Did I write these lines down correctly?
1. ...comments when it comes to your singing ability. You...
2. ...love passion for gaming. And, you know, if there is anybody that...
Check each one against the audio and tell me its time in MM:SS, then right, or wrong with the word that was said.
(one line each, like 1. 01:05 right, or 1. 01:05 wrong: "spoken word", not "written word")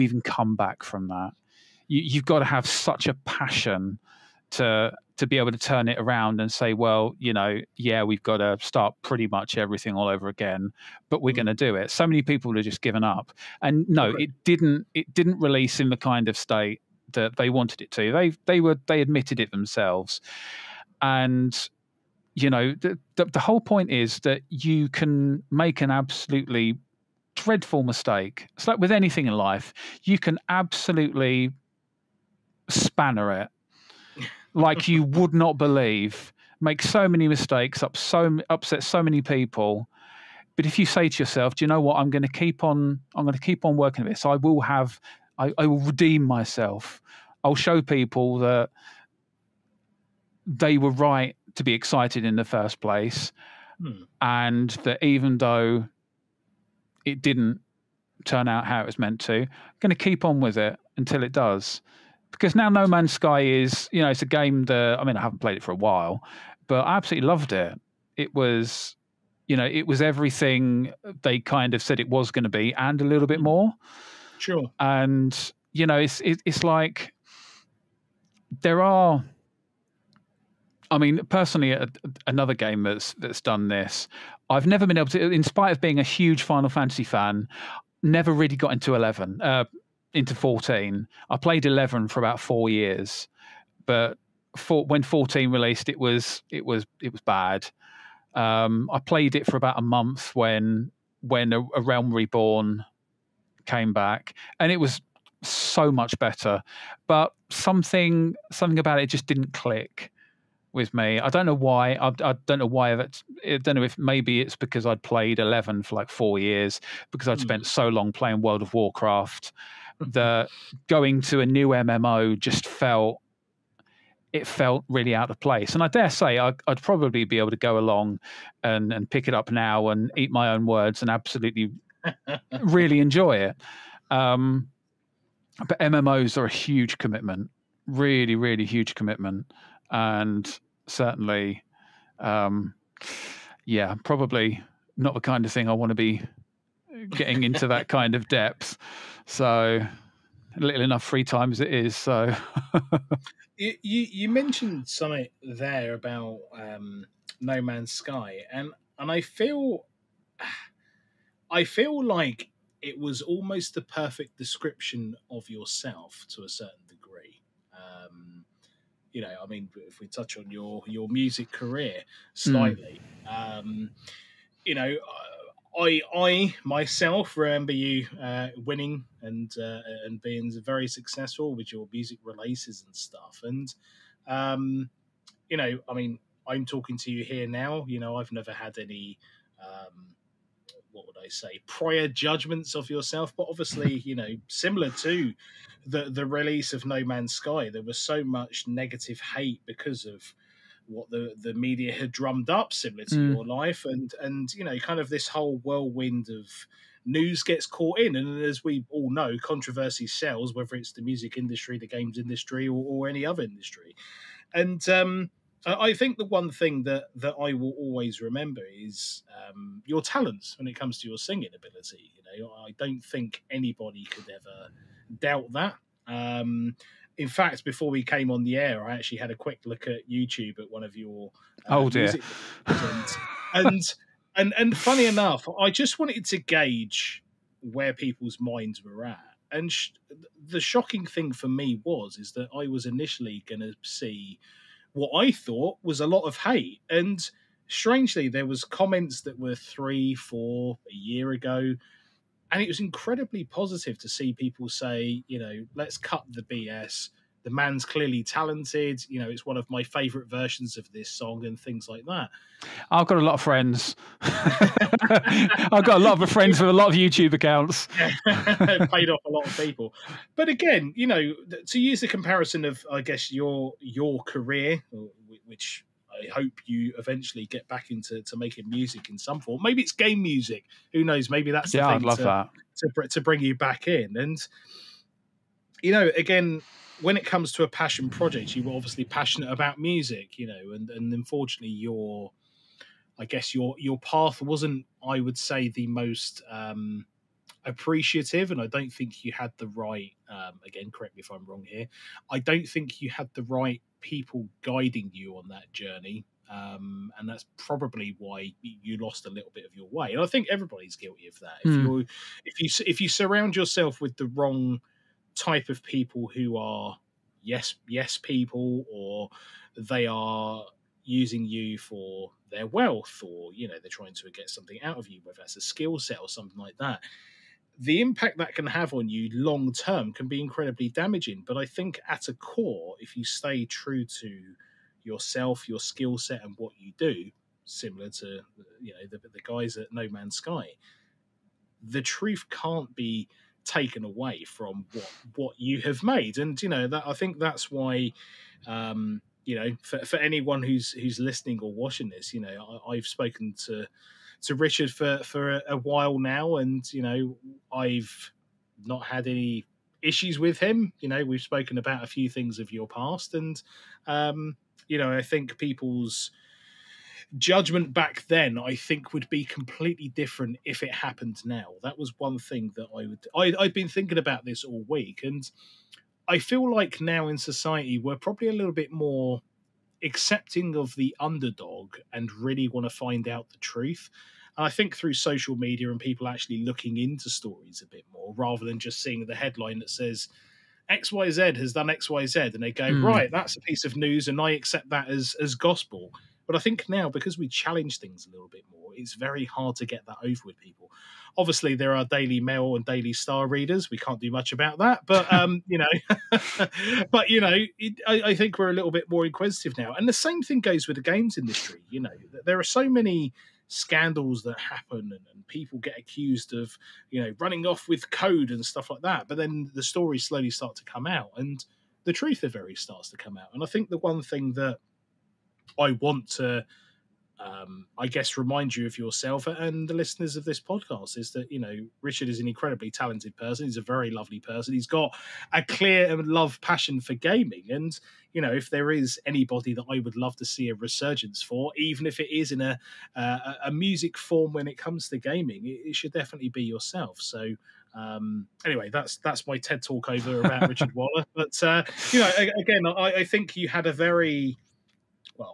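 1. 03:40 wrong: "talents", not "comments"
2. 07:16 right.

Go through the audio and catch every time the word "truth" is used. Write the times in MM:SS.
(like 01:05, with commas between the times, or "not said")
05:42, 06:23, 07:02.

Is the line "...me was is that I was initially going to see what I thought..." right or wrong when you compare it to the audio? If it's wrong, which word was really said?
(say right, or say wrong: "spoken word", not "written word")
right.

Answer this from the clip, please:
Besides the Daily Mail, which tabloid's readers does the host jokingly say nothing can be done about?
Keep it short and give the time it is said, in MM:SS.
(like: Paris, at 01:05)
Daily Star, at 06:42.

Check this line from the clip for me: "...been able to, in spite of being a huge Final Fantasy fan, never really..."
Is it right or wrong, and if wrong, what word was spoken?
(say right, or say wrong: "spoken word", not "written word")
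right.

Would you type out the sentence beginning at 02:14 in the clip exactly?
Um, but MMOs are a huge commitment, really, really huge commitment.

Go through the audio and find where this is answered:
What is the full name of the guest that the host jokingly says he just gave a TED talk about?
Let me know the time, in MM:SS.
07:30.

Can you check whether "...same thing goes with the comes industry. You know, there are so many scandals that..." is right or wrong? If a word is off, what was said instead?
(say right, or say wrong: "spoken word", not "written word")
wrong: "games", not "comes".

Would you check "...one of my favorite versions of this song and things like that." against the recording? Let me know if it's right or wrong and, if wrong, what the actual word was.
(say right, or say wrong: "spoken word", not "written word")
right.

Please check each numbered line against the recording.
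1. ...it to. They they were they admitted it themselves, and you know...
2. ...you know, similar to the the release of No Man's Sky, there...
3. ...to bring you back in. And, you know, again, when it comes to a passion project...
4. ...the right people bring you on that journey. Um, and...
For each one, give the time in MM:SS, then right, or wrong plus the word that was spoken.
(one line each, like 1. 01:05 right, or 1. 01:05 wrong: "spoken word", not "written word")
1. 00:17 right
2. 03:14 right
3. 04:43 right
4. 05:03 wrong: "guiding", not "bring".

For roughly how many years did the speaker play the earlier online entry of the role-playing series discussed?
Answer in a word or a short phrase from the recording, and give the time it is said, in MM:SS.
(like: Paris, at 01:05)
4 years, at 01:32.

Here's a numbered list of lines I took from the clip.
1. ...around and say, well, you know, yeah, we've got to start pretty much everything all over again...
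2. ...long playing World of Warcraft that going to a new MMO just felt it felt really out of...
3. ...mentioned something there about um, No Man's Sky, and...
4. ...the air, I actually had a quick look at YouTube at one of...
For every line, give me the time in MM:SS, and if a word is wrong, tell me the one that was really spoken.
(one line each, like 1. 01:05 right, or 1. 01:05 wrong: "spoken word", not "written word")
1. 00:05 right
2. 01:57 right
3. 02:34 right
4. 03:48 right.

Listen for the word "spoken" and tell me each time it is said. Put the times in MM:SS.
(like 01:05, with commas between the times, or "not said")
05:53, 06:01.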